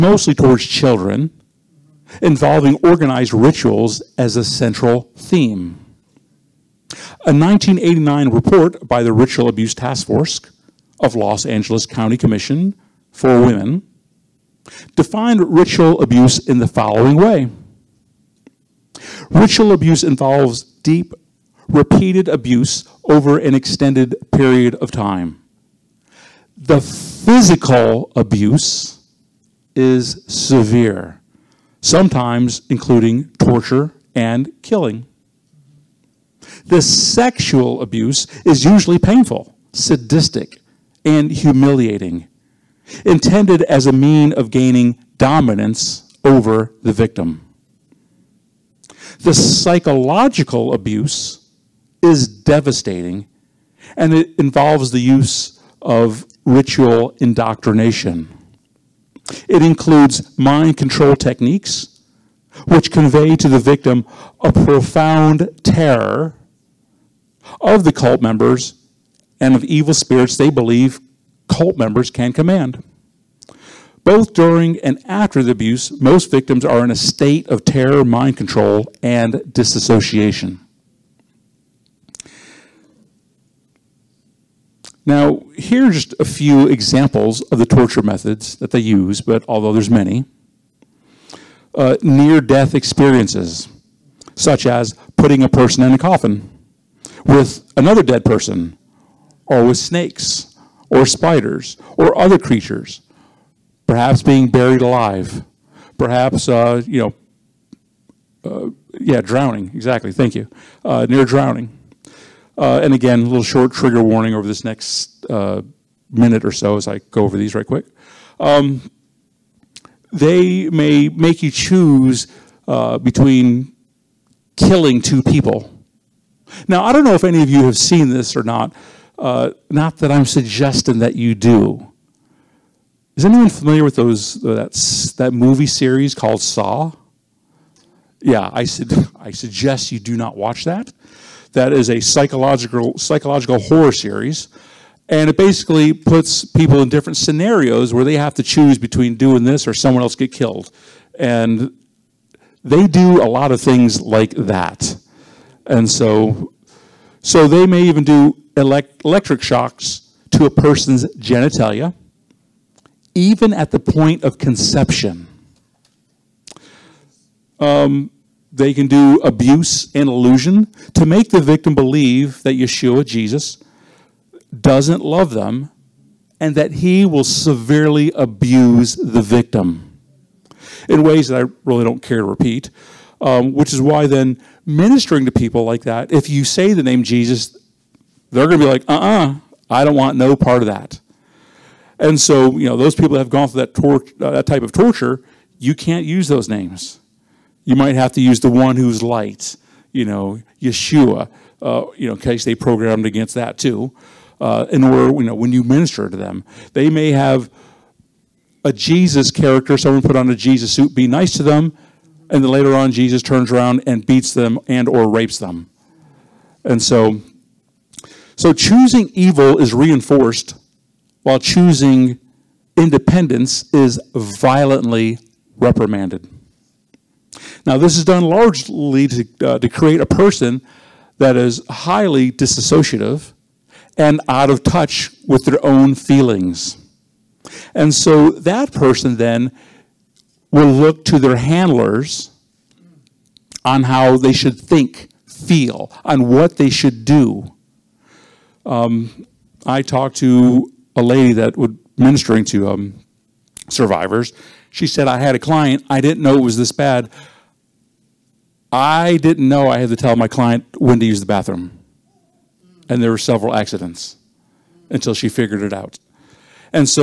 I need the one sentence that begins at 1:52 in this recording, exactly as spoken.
Uh, and again, a little short trigger warning over this next uh, minute or so as I go over these right quick.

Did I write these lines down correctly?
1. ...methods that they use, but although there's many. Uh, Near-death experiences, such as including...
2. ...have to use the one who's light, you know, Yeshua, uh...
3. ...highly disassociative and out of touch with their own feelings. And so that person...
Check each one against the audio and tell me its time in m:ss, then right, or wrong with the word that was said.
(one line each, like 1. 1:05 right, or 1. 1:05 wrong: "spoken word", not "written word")
1. 1:28 wrong: "putting", not "including"
2. 3:17 right
3. 3:51 right.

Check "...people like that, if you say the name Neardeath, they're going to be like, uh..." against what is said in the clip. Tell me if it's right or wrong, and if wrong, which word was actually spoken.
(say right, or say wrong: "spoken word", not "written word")
wrong: "Jesus", not "Neardeath".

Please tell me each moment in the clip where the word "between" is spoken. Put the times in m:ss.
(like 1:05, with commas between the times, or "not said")
2:02, 2:28.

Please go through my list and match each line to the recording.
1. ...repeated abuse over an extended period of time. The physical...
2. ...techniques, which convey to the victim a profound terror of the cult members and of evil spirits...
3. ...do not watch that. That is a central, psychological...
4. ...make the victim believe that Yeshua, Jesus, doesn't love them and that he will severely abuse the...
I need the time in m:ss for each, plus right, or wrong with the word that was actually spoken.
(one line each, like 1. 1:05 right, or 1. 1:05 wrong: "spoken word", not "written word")
1. 0:21 right
2. 1:01 right
3. 2:19 wrong: "psychological", not "central"
4. 2:51 right.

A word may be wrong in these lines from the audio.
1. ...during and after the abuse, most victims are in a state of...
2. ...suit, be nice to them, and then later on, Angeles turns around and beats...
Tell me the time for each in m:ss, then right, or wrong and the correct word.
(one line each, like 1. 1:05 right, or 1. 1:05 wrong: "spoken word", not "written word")
1. 1:14 right
2. 3:30 wrong: "Jesus", not "Angeles".